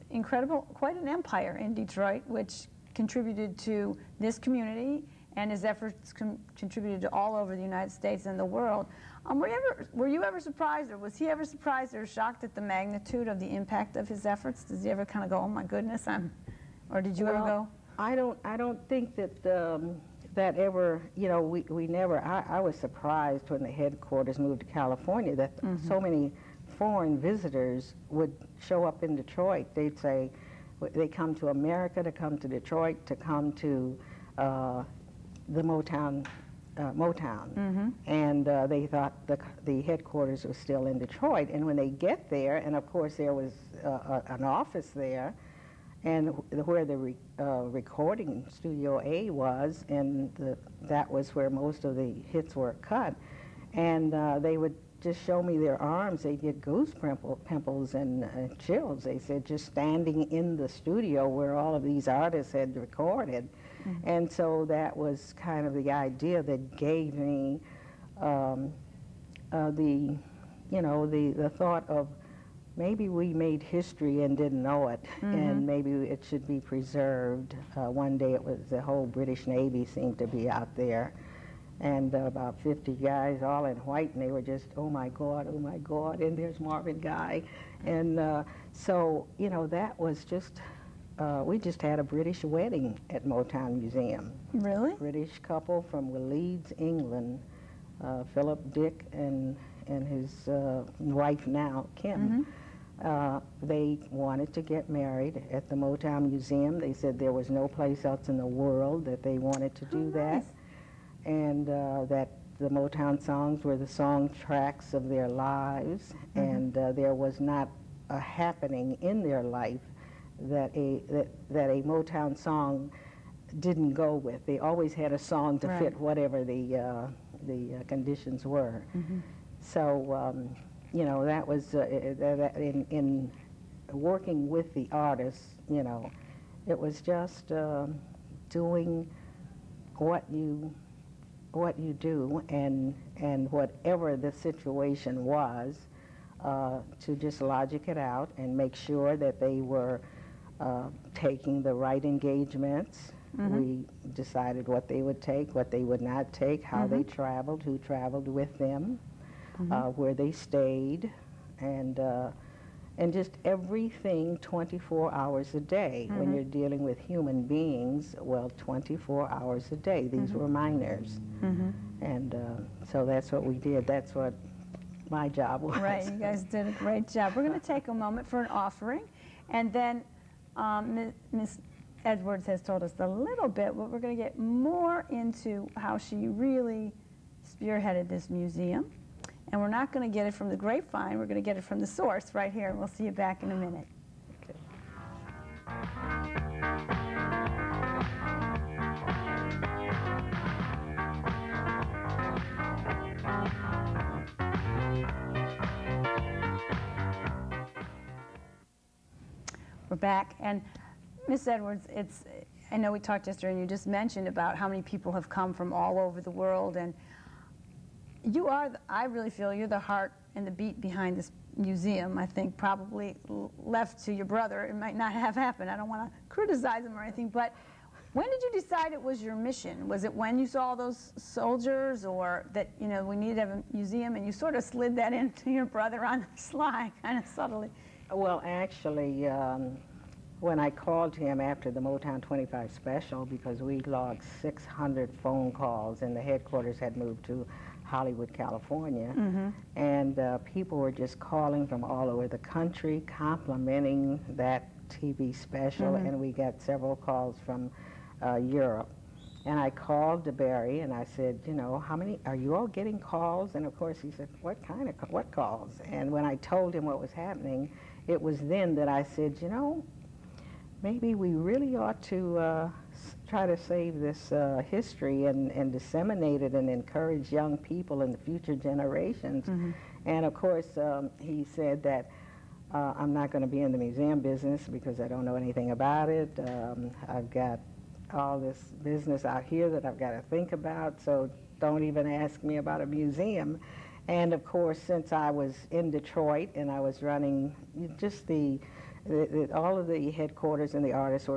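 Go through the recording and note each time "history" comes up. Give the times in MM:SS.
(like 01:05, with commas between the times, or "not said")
01:13, 04:34.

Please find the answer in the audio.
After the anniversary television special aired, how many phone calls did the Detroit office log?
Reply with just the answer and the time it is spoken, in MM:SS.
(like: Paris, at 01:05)
600, at 04:04.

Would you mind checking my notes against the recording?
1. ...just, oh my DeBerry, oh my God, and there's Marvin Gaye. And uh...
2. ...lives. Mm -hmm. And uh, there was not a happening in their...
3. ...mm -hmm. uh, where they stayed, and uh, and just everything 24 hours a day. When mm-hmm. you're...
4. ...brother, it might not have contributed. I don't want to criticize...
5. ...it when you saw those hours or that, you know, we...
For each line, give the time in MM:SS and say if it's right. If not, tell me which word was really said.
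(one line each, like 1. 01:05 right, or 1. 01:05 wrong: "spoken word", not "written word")
1. 01:24 wrong: "God", not "DeBerry"
2. 01:55 right
3. 02:38 right
4. 03:44 wrong: "happened", not "contributed"
5. 03:50 wrong: "soldiers", not "hours".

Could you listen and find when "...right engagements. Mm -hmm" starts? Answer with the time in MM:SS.
02:31.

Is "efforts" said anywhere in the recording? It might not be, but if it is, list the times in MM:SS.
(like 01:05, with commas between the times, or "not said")
00:05, 00:14.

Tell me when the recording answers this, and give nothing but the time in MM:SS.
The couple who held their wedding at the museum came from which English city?
01:36.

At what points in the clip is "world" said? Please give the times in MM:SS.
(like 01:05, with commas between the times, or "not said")
00:08, 01:48, 03:36.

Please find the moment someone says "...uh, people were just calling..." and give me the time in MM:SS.
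04:10.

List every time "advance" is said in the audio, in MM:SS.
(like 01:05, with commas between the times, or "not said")
not said.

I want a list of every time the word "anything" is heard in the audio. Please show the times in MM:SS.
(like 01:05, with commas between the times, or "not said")
03:47, 04:45.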